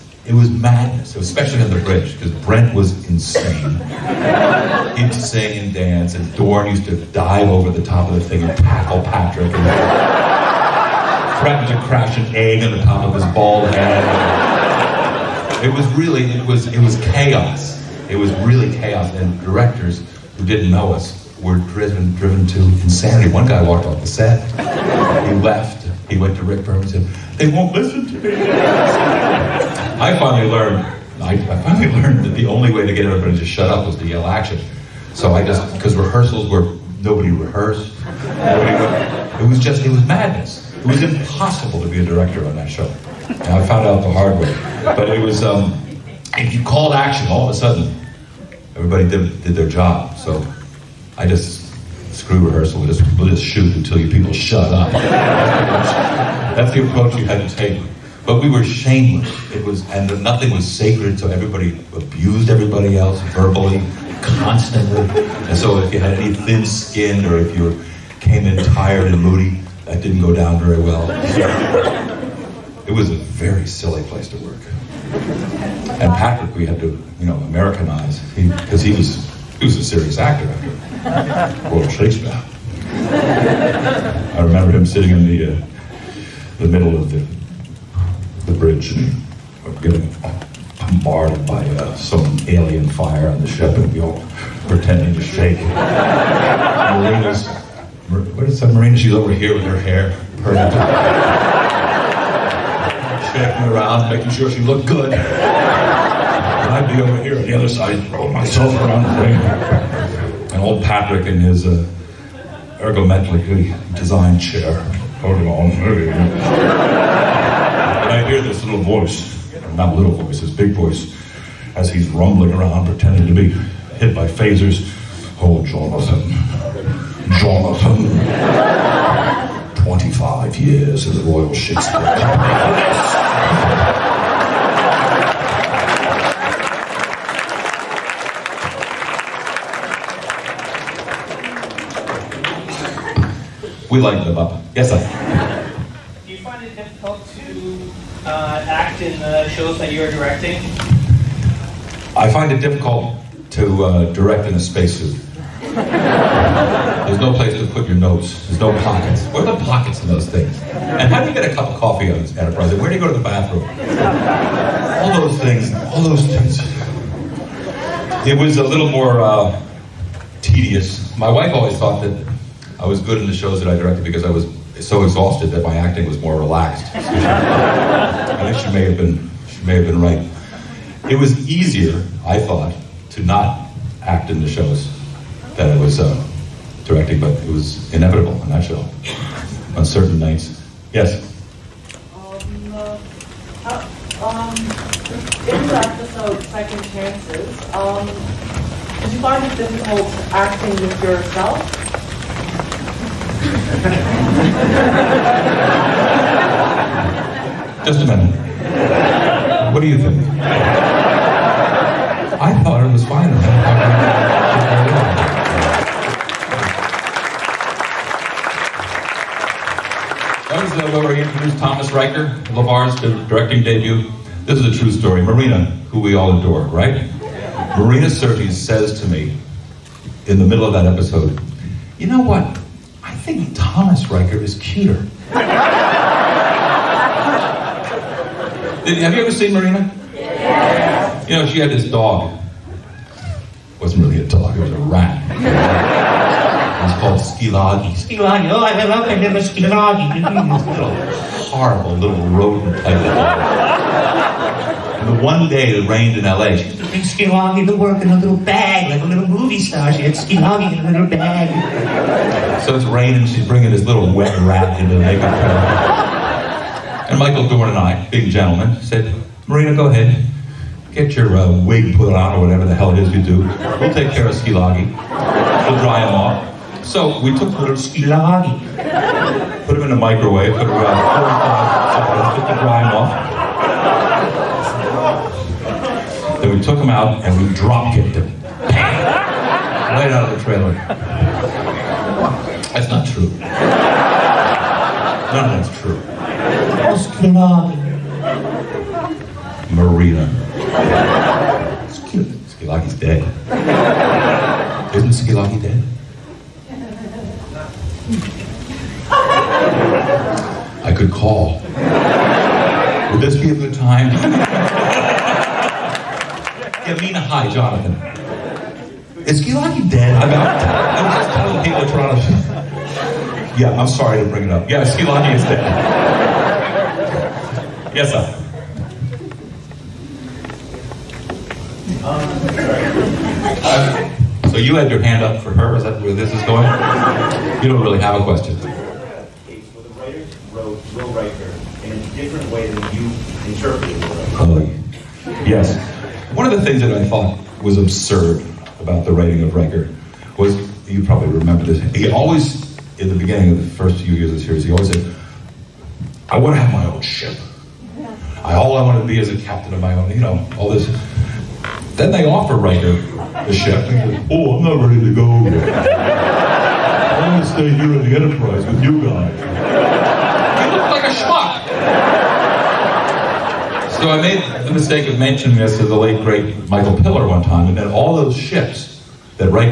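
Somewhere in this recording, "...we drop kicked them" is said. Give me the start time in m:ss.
4:47.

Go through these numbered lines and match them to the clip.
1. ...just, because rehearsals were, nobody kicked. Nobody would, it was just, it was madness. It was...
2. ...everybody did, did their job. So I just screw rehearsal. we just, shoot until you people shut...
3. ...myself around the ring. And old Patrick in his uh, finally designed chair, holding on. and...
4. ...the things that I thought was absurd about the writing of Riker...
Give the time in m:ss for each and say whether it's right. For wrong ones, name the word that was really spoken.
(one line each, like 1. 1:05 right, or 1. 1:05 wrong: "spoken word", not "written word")
1. 0:35 wrong: "rehearsed", not "kicked"
2. 0:48 right
3. 1:48 wrong: "ergometrically", not "finally"
4. 5:46 right.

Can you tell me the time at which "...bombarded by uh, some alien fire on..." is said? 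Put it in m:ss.
1:30.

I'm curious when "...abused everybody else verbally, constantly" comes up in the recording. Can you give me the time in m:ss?
1:01.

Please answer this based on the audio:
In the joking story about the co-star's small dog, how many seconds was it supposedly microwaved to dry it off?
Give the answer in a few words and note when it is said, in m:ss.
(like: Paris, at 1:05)
45, at 4:41.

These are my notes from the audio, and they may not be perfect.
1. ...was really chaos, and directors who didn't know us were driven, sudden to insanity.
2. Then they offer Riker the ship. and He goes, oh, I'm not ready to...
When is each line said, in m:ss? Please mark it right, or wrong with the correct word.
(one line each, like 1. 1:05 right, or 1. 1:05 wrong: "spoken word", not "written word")
1. 0:18 wrong: "driven", not "sudden"
2. 6:01 right.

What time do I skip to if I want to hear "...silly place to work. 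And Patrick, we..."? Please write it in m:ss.
1:13.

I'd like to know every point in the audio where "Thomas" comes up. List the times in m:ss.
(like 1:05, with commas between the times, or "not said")
3:41, 3:53.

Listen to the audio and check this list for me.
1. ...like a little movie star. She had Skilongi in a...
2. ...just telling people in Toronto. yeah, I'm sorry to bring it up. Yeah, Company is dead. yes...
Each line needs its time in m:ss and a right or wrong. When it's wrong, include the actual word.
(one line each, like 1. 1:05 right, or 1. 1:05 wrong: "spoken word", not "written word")
1. 4:18 right
2. 5:21 wrong: "Gilaki", not "Company".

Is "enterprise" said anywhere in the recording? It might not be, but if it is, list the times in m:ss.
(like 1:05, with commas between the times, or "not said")
2:42, 6:08.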